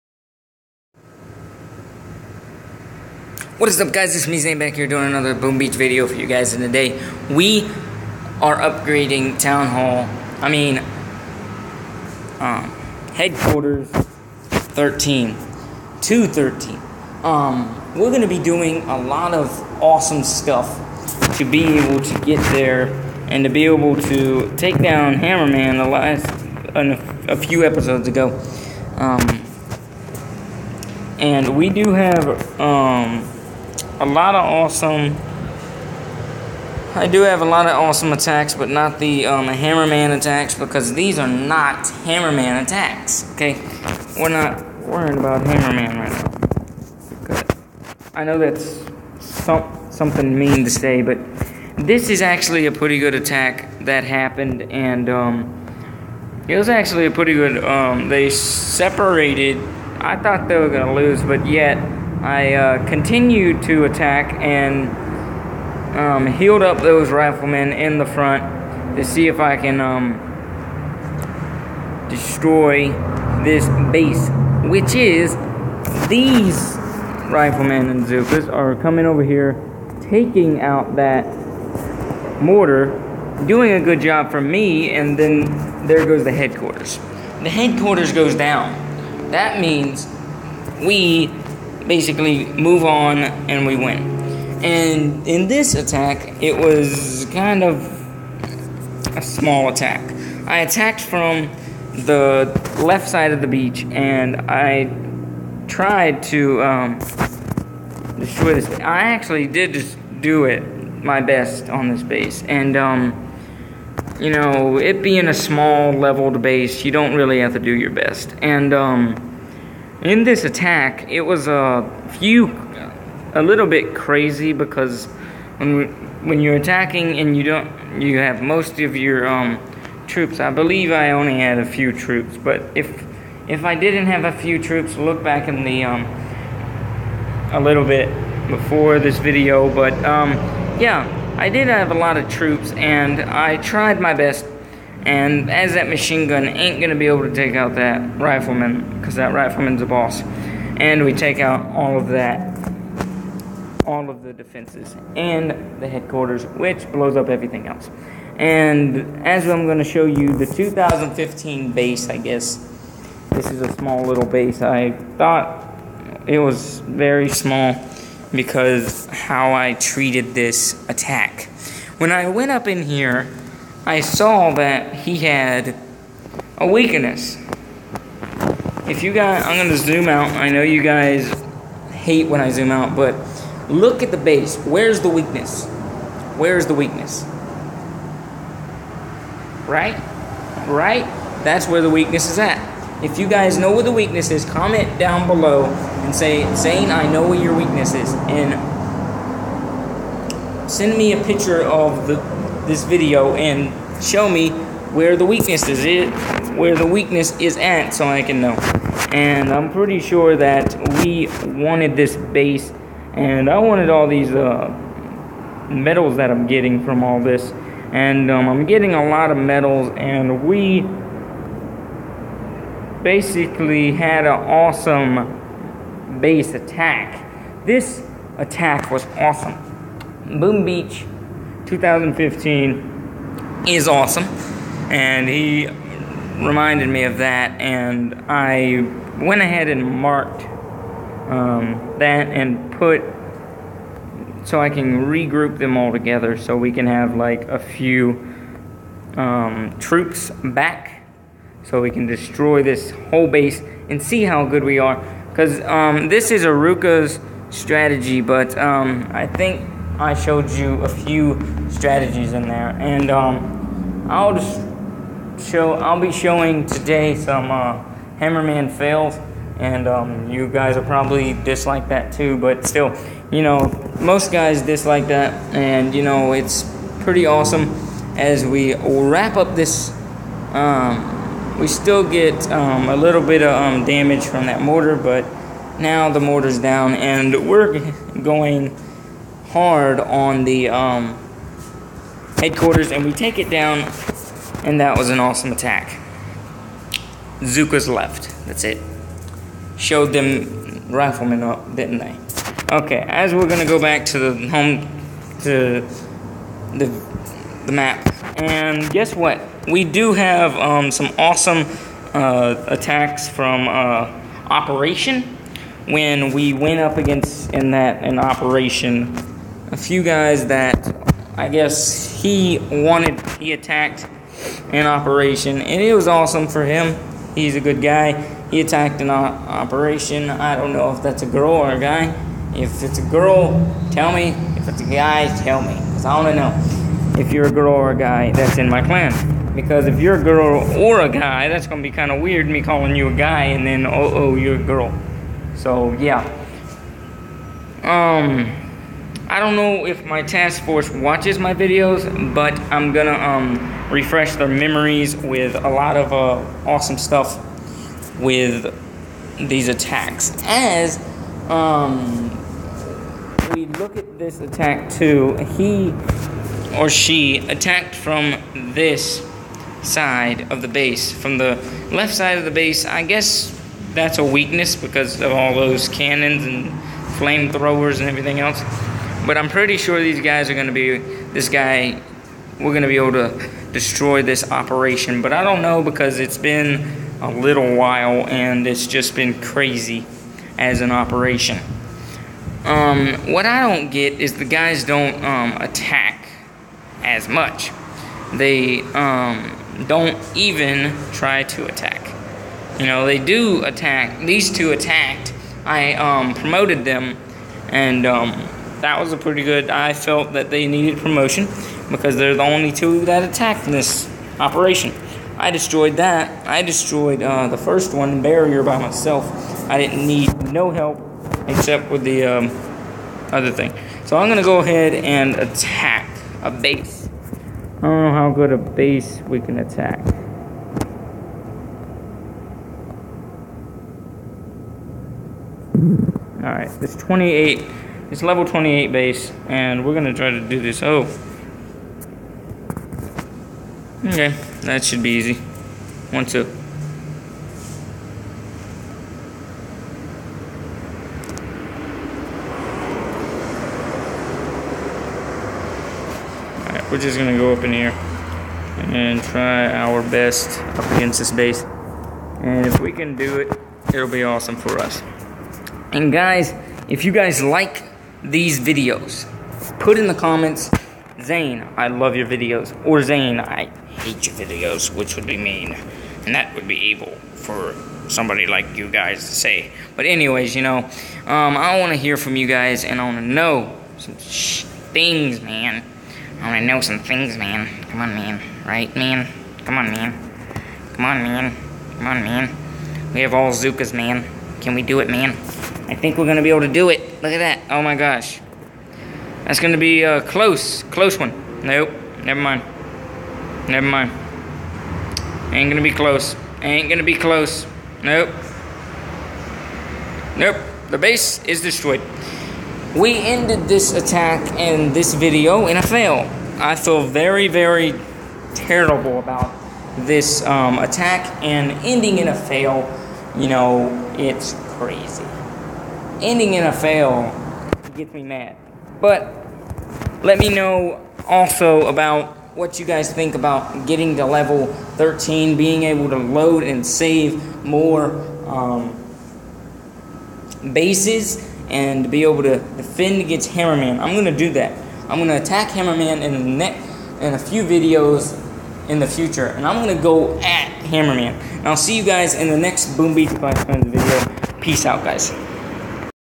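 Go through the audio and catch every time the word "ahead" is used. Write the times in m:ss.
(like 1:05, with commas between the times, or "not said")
3:59, 7:04.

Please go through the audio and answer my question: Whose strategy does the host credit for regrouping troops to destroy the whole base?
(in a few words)
Aruka.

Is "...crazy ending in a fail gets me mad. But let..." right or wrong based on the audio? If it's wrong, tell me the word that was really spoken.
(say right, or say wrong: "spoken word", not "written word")
right.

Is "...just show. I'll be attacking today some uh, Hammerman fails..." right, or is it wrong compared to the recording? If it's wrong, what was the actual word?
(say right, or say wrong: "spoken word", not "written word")
wrong: "showing", not "attacking".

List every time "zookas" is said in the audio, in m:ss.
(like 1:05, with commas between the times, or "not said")
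1:18, 4:57, 8:13.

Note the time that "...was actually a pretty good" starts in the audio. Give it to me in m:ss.
0:56.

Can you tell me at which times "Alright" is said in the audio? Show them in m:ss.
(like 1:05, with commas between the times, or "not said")
7:16, 7:36.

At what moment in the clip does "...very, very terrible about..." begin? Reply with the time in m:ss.
8:37.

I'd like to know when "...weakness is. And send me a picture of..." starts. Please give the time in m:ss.
3:17.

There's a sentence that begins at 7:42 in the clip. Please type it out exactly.
And if we can do it, it'll be awesome for us.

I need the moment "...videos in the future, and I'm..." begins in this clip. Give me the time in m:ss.
9:07.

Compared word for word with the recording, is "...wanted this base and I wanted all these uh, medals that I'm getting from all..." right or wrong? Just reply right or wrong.
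right.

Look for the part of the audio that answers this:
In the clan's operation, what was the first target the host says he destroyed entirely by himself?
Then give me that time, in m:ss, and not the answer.
6:58.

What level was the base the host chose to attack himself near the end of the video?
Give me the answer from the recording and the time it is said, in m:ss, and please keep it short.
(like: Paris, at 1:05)
28, at 7:18.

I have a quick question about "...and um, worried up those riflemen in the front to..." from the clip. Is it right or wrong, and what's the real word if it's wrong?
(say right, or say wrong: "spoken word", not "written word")
wrong: "healed", not "worried".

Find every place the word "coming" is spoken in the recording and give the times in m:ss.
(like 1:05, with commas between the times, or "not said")
1:18.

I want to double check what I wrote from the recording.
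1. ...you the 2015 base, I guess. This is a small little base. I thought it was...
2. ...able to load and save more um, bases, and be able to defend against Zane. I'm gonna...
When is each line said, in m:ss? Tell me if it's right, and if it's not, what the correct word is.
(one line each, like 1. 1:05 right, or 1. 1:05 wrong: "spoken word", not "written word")
1. 2:40 right
2. 8:55 wrong: "Hammerman", not "Zane".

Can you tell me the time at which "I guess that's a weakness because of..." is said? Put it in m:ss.
6:12.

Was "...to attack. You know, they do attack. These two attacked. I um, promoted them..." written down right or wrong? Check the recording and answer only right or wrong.
right.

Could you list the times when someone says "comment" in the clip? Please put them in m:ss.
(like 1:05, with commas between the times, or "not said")
3:14, 7:50.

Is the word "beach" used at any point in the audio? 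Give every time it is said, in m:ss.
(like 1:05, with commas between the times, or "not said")
0:05, 1:43, 3:50, 9:13.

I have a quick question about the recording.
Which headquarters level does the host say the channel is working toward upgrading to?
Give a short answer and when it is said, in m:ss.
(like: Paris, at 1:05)
13, at 0:13.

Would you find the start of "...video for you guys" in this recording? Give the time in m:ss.
0:05.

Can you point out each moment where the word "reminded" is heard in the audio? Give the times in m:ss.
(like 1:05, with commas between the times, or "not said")
3:56.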